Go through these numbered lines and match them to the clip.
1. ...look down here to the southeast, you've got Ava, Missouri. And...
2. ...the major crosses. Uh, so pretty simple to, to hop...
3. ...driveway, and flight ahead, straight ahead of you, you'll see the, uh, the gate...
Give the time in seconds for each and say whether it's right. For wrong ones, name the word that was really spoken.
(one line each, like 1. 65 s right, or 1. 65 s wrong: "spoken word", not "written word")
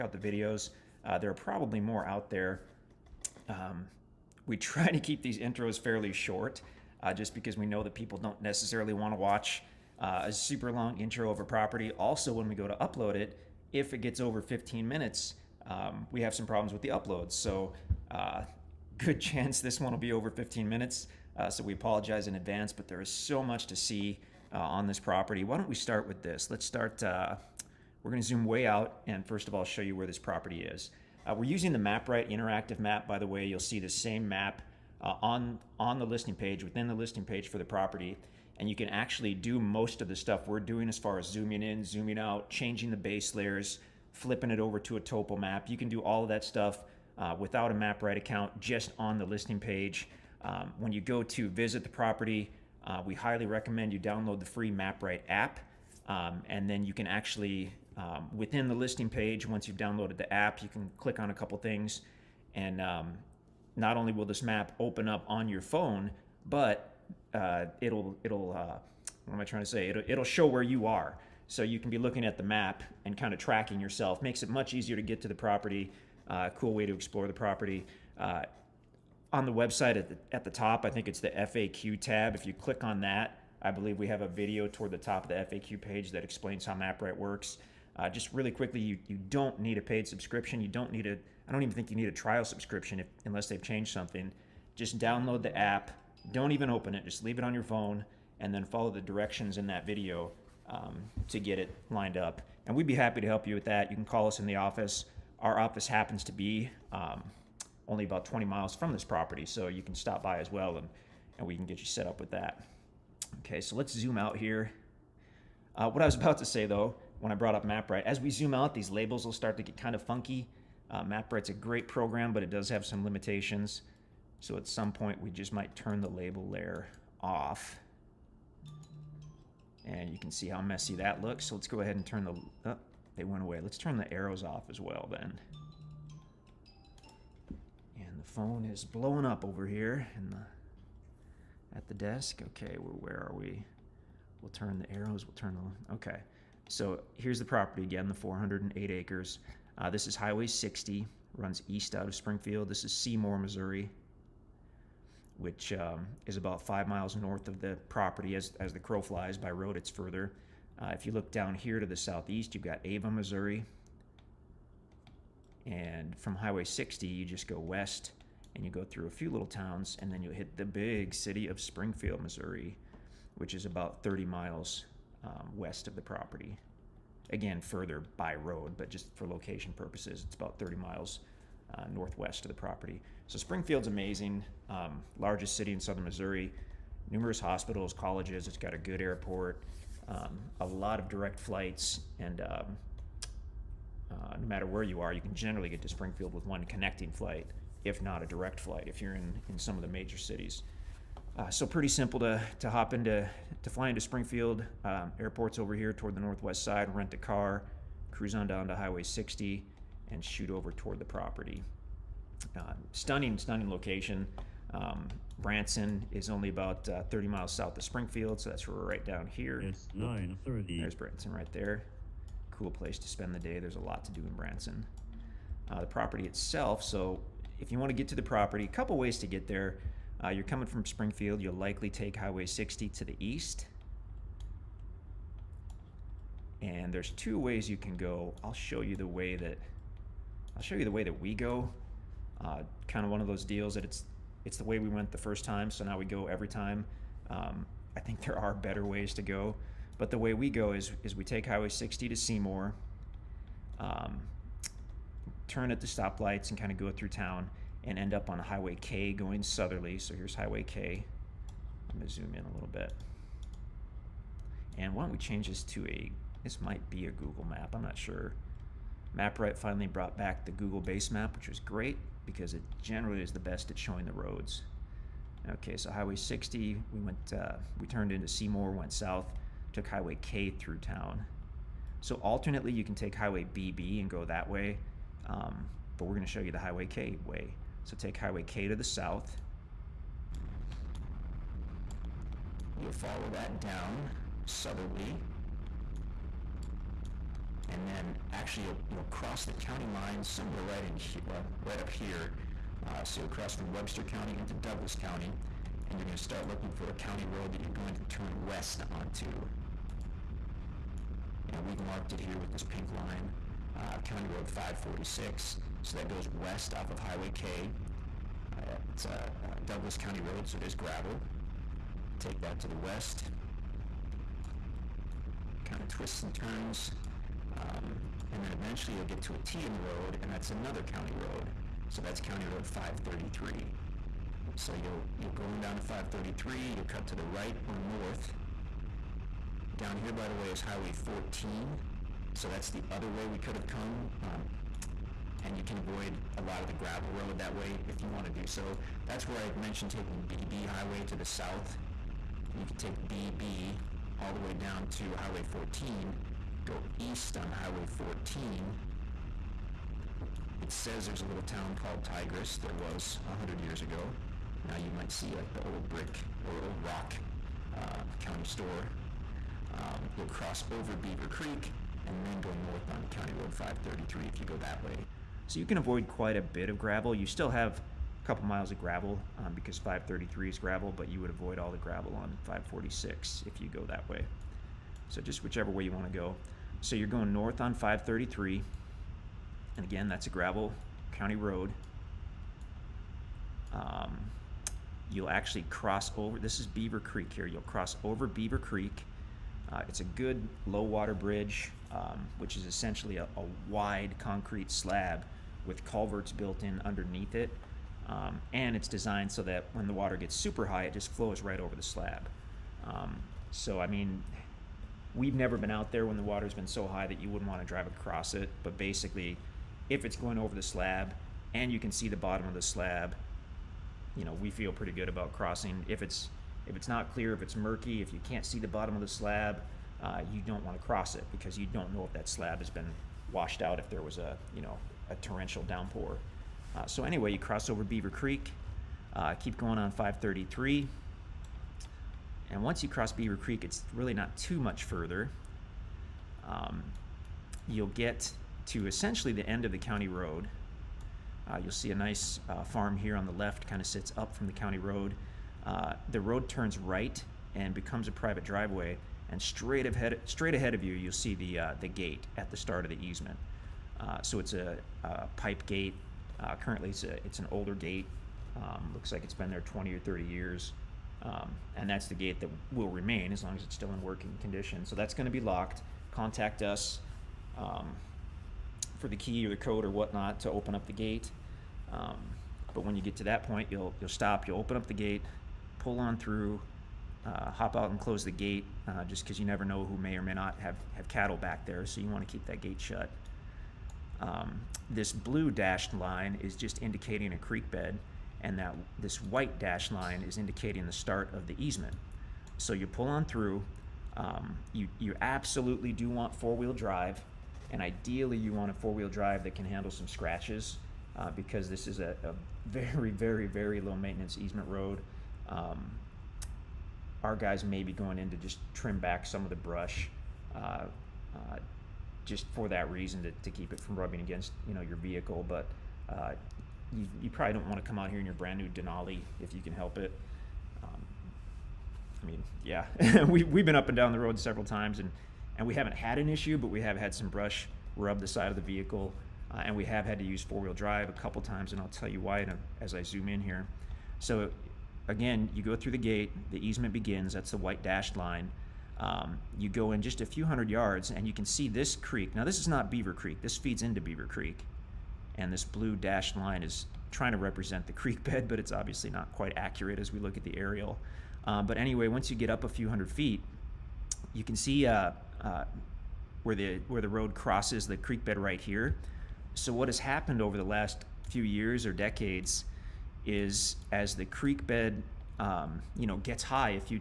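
1. 161 s right
2. 199 s wrong: "cities", not "crosses"
3. 458 s wrong: "straight", not "flight".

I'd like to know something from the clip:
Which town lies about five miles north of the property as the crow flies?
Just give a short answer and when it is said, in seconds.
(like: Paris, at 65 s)
Seymour, Missouri, at 152 s.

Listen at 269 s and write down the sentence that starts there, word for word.
MapRight finally brought back the Google base map, which was great because it generally is the best at showing the roads.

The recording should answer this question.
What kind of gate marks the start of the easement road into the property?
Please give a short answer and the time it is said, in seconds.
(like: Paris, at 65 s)
pipe gate, at 465 s.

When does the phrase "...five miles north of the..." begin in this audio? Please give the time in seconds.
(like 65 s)
156 s.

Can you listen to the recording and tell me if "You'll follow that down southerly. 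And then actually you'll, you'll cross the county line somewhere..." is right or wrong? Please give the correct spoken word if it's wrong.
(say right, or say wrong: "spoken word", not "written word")
right.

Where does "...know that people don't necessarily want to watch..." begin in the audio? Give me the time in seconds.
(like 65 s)
7 s.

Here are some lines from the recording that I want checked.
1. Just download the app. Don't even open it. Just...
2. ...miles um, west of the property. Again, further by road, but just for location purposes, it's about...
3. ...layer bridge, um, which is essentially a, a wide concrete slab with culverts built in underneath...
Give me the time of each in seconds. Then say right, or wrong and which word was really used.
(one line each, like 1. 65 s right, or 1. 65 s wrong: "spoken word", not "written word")
1. 94 s right
2. 174 s right
3. 400 s wrong: "water", not "layer".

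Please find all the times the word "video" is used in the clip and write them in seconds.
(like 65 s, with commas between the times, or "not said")
0 s, 84 s, 99 s.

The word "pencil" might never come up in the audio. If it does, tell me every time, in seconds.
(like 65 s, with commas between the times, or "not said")
not said.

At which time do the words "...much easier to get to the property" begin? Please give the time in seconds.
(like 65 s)
74 s.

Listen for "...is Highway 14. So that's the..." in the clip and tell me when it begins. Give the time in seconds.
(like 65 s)
340 s.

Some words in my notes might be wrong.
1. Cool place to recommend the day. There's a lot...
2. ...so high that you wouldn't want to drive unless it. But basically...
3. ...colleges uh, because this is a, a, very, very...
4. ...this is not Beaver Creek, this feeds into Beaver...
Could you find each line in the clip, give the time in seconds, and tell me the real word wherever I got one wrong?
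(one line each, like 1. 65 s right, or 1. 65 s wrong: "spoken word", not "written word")
1. 222 s wrong: "spend", not "recommend"
2. 416 s wrong: "across", not "unless"
3. 510 s wrong: "scratches", not "colleges"
4. 552 s right.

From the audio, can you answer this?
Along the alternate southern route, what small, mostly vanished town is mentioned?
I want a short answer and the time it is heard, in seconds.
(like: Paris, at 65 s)
Tigris, at 362 s.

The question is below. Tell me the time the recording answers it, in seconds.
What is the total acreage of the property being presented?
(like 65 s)
148 s.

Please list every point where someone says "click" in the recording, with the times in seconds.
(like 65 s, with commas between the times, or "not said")
60 s, 82 s.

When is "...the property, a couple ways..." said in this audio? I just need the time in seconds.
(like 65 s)
228 s.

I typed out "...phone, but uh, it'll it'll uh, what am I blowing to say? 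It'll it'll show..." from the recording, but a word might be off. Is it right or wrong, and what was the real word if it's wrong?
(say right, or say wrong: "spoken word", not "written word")
wrong: "trying", not "blowing".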